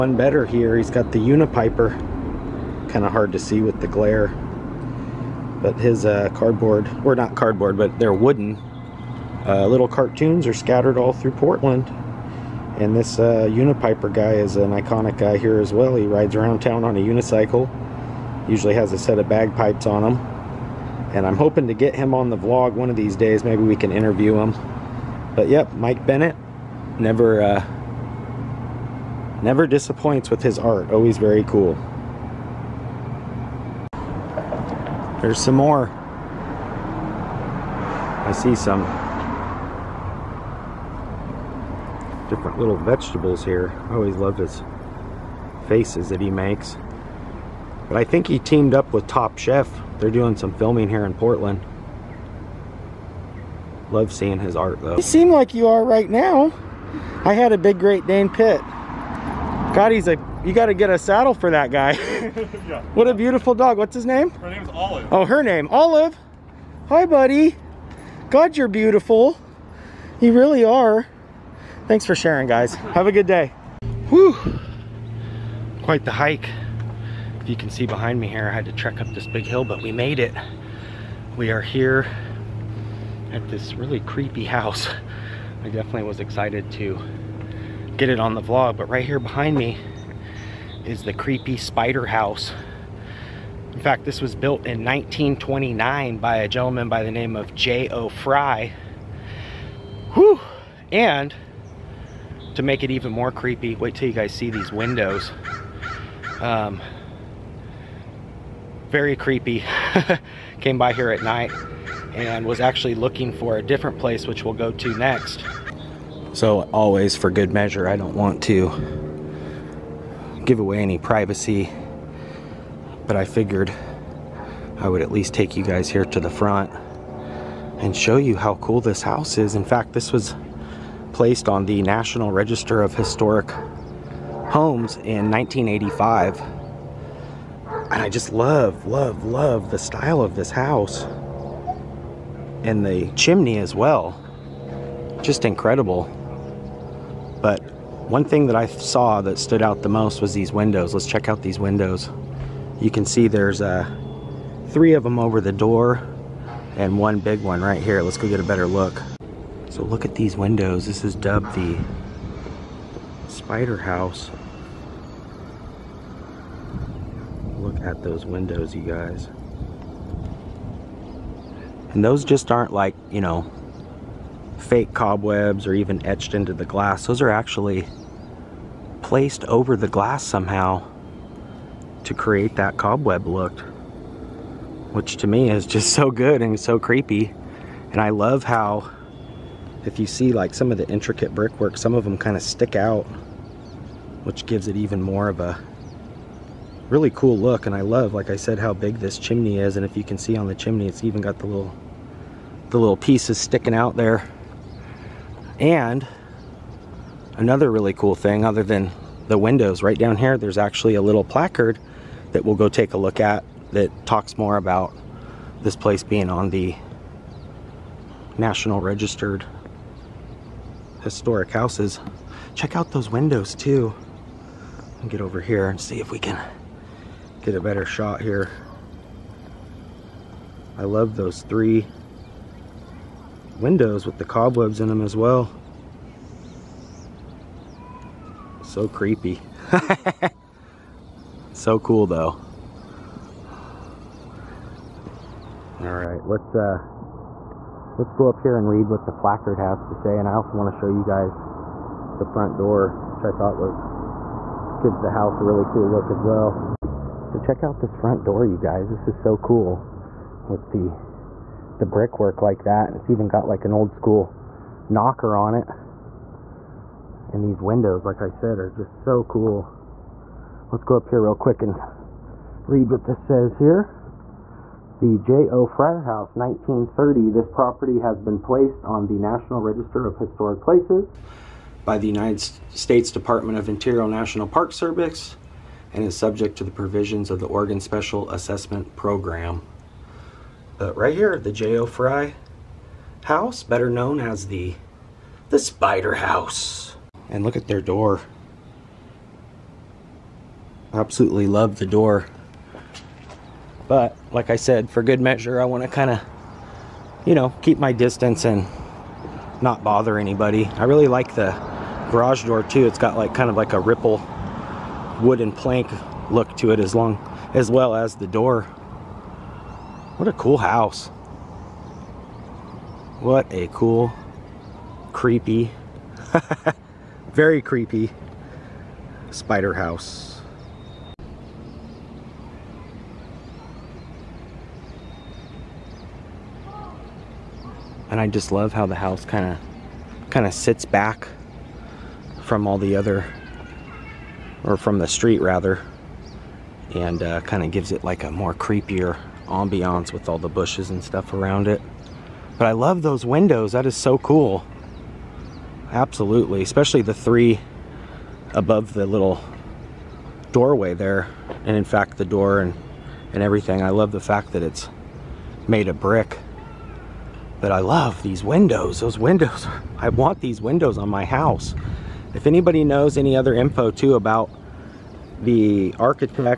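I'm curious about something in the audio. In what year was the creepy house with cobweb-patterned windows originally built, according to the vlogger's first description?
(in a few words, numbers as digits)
1929.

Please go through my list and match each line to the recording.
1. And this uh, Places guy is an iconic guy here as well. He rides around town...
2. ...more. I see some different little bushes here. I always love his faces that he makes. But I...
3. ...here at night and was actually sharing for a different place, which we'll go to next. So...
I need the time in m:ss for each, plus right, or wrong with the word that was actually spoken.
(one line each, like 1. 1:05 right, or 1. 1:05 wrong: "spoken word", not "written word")
1. 0:12 wrong: "Unipiper", not "Places"
2. 0:35 wrong: "vegetables", not "bushes"
3. 1:50 wrong: "looking", not "sharing".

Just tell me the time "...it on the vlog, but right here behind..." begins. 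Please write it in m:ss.
1:28.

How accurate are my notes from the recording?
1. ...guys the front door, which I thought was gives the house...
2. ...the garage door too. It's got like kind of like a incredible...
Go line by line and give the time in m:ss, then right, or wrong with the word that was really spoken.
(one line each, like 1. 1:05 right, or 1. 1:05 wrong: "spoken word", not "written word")
1. 4:11 right
2. 5:11 wrong: "ripple", not "incredible".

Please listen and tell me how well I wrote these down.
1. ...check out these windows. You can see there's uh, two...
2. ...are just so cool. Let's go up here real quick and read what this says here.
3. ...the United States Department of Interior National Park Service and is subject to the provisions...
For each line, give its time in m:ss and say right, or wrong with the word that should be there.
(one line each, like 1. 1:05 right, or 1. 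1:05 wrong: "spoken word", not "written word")
1. 2:31 wrong: "three", not "two"
2. 4:28 right
3. 4:41 right.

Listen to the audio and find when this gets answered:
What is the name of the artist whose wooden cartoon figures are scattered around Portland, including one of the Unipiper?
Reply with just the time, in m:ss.
0:25.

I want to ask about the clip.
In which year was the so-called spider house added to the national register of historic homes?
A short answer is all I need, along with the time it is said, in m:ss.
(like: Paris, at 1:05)
1985, at 2:15.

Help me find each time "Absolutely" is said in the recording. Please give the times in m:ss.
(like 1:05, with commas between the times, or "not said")
5:00, 5:55.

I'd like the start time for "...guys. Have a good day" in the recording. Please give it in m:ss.
1:12.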